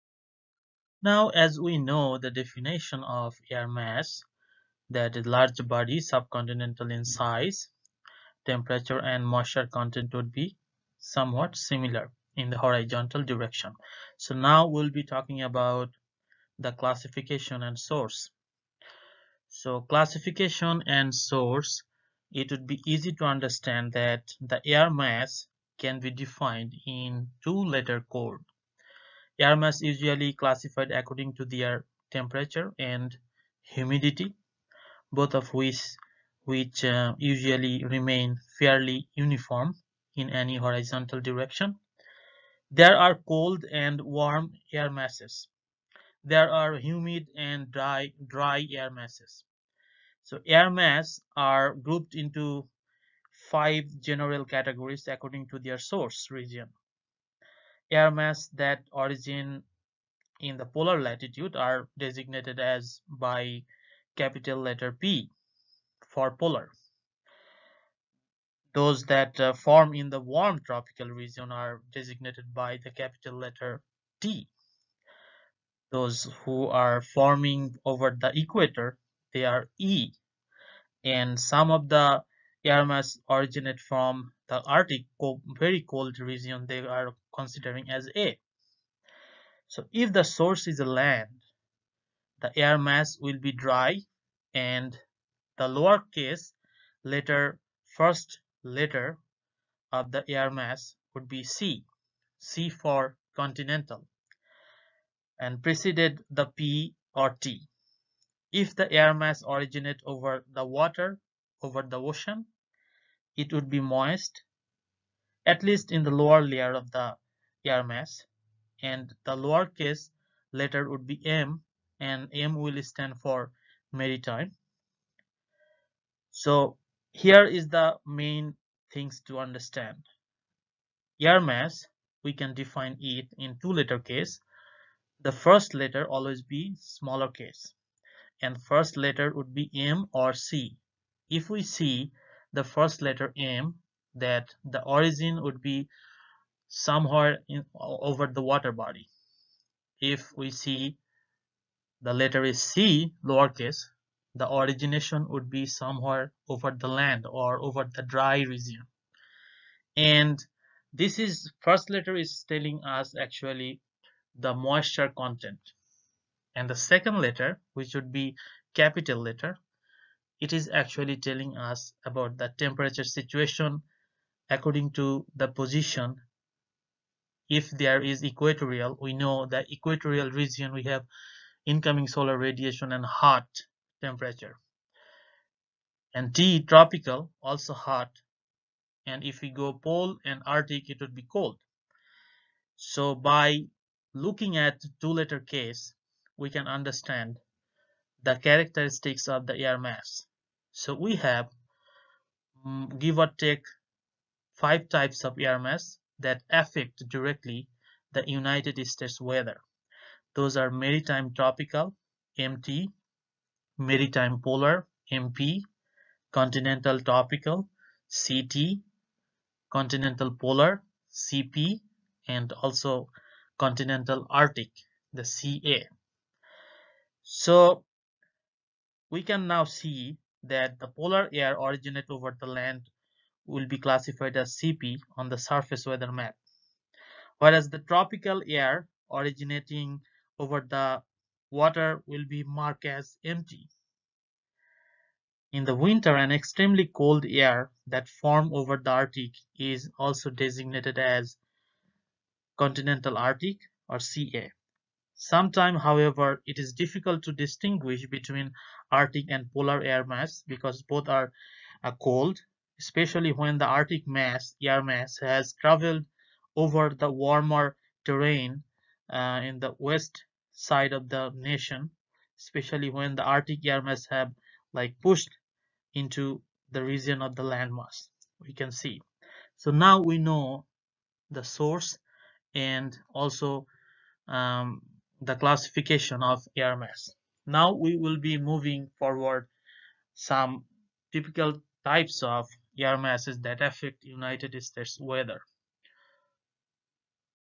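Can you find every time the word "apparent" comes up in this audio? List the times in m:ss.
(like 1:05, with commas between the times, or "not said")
not said.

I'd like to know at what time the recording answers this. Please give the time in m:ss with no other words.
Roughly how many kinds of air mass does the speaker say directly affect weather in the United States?
3:24.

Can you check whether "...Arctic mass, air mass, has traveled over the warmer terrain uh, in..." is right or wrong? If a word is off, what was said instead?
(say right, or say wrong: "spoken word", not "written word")
right.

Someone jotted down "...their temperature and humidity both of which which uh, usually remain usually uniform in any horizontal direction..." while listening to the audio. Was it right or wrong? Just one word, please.
wrong.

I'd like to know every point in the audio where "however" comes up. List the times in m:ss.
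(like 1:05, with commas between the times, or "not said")
4:15.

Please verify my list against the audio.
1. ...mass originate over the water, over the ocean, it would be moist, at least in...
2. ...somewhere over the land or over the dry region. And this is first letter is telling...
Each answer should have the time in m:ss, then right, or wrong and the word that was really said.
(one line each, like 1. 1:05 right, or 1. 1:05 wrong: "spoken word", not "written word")
1. 1:49 right
2. 2:35 right.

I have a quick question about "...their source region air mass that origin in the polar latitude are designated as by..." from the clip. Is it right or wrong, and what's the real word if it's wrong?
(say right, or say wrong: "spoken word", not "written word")
right.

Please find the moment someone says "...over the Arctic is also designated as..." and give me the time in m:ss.
4:08.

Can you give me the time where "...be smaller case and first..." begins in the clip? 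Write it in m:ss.
2:16.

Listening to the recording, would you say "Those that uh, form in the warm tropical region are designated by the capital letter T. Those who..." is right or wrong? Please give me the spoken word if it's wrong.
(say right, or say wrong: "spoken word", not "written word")
right.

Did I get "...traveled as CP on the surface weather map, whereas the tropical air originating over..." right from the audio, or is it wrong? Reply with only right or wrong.
wrong.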